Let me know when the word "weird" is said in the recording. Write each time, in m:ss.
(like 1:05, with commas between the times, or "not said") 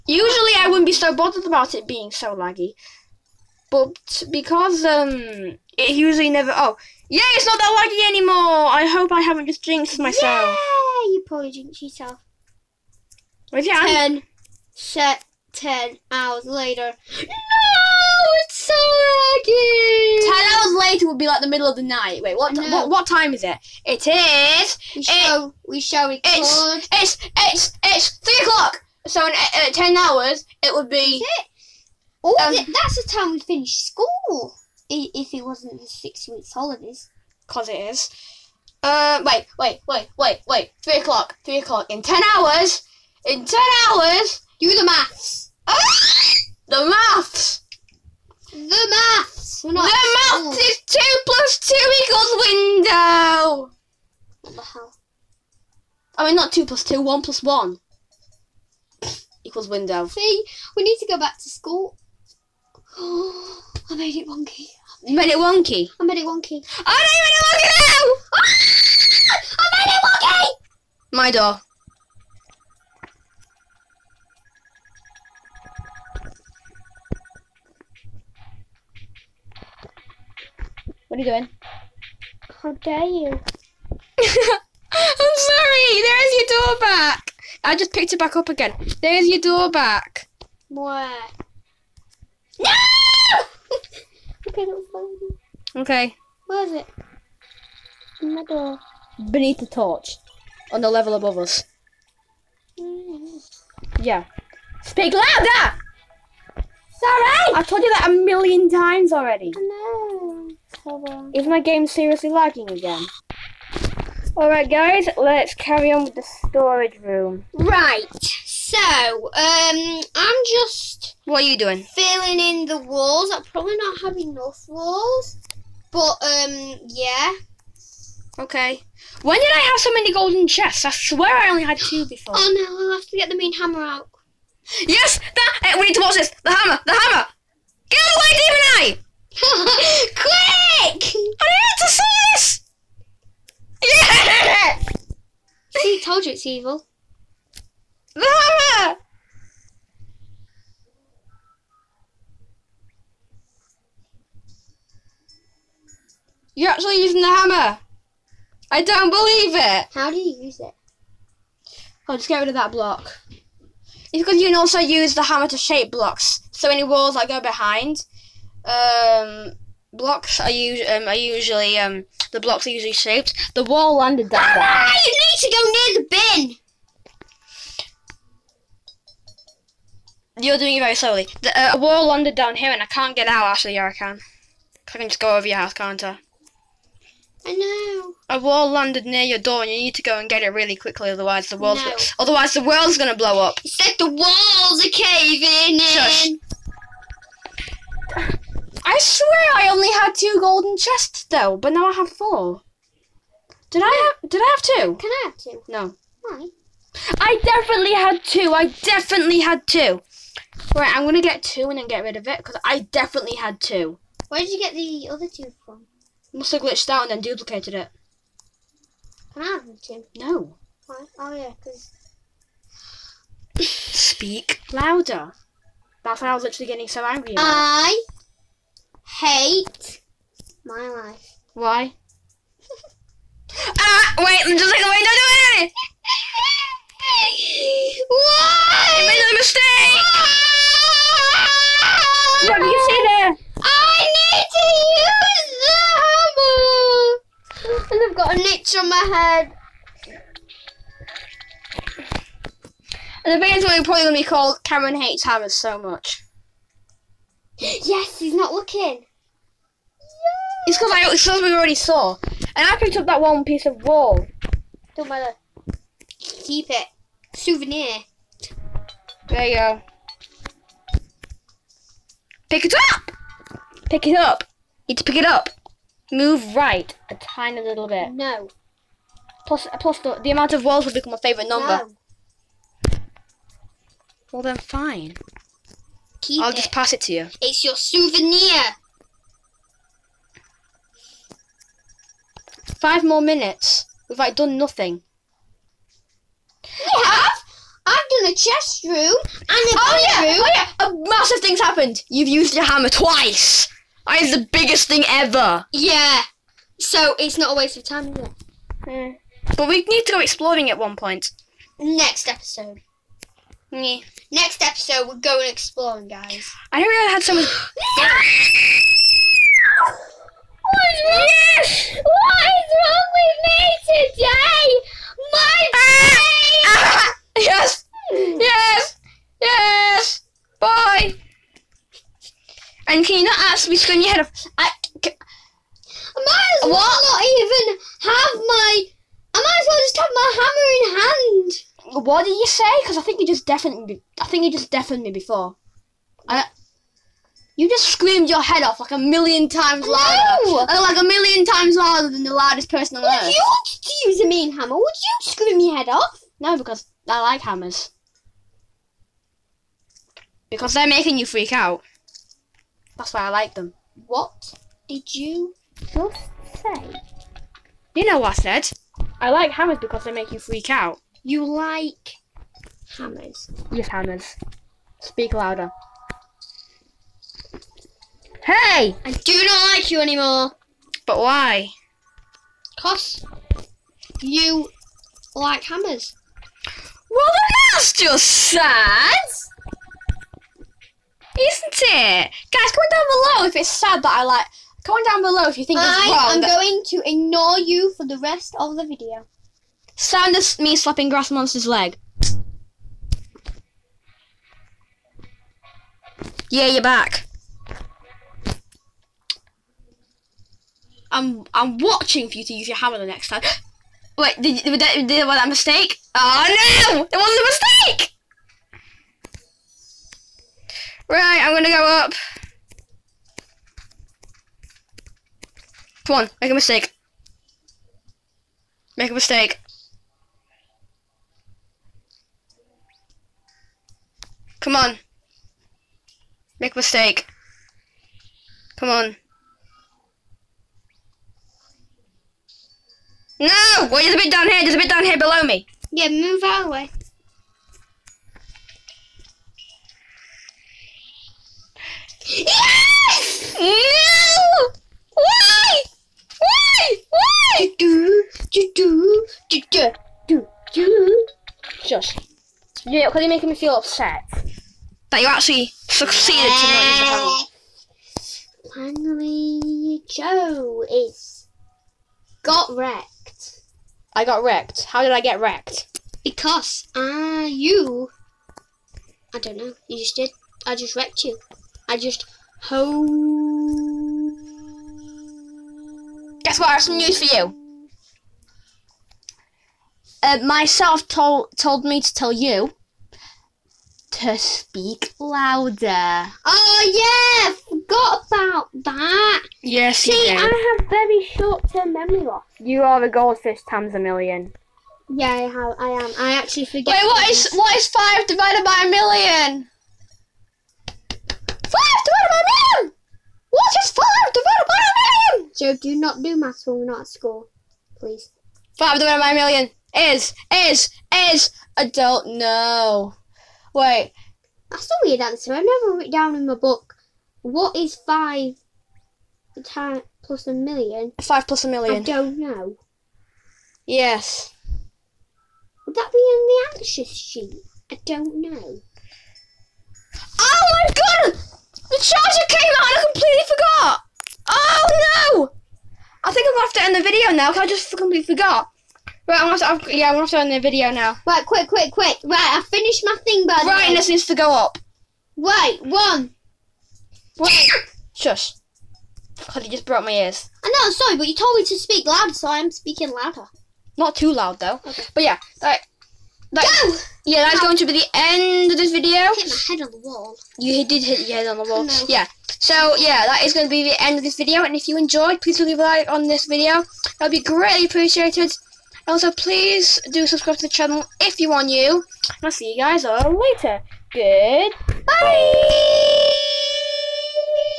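8:45.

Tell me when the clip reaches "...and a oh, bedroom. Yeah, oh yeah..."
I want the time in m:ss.
4:58.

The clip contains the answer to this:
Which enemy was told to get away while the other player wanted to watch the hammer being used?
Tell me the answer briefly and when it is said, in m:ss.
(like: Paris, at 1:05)
demon eye, at 2:18.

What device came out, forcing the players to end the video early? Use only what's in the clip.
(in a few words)
the charger.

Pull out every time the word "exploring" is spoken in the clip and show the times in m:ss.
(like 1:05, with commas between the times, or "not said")
5:10, 5:15.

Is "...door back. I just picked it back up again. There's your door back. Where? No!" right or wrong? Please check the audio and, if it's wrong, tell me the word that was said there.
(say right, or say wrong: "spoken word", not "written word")
right.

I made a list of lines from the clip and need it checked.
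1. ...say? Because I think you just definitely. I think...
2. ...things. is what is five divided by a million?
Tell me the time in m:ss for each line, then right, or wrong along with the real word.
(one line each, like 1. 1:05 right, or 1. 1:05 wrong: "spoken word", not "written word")
1. 5:42 right
2. 8:27 right.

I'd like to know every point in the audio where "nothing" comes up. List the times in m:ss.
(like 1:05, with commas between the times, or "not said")
4:54.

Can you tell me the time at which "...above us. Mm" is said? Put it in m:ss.
1:41.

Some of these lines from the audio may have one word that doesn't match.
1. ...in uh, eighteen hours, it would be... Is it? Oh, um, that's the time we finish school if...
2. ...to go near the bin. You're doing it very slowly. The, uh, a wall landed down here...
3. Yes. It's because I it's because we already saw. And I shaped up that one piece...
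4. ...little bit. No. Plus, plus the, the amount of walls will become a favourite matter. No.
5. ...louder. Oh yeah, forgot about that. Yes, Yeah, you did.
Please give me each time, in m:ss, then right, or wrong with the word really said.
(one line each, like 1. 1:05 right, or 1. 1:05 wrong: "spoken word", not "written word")
1. 0:29 wrong: "ten", not "eighteen"
2. 2:55 right
3. 4:19 wrong: "picked", not "shaped"
4. 4:37 wrong: "number", not "matter"
5. 8:15 wrong: "See", not "Yeah".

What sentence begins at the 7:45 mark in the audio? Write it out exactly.
That you actually succeeded to not use the Finally, Joe is got wrecked.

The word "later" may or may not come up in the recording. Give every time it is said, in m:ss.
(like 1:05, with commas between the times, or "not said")
0:16, 0:20, 9:43.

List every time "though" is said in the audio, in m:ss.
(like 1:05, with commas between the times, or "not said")
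3:21, 9:24.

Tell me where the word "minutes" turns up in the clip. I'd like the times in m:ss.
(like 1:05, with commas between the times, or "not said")
4:53.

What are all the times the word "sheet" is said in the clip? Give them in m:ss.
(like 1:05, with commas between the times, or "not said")
8:57.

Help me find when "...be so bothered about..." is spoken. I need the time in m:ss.
0:00.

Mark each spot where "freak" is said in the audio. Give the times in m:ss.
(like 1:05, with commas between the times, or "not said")
6:01, 6:10.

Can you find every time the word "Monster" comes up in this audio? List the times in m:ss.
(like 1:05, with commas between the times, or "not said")
6:41.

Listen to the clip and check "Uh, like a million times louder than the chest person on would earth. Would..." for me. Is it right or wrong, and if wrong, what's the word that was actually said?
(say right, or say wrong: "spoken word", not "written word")
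wrong: "loudest", not "chest".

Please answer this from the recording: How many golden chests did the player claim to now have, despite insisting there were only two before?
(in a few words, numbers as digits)
4.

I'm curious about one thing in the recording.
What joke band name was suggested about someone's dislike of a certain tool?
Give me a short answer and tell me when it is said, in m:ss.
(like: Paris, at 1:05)
Cameron Hates Hammers, at 4:14.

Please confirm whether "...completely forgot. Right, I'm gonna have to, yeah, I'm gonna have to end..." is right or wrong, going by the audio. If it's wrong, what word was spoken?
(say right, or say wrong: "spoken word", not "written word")
right.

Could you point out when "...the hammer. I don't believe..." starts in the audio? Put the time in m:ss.
2:37.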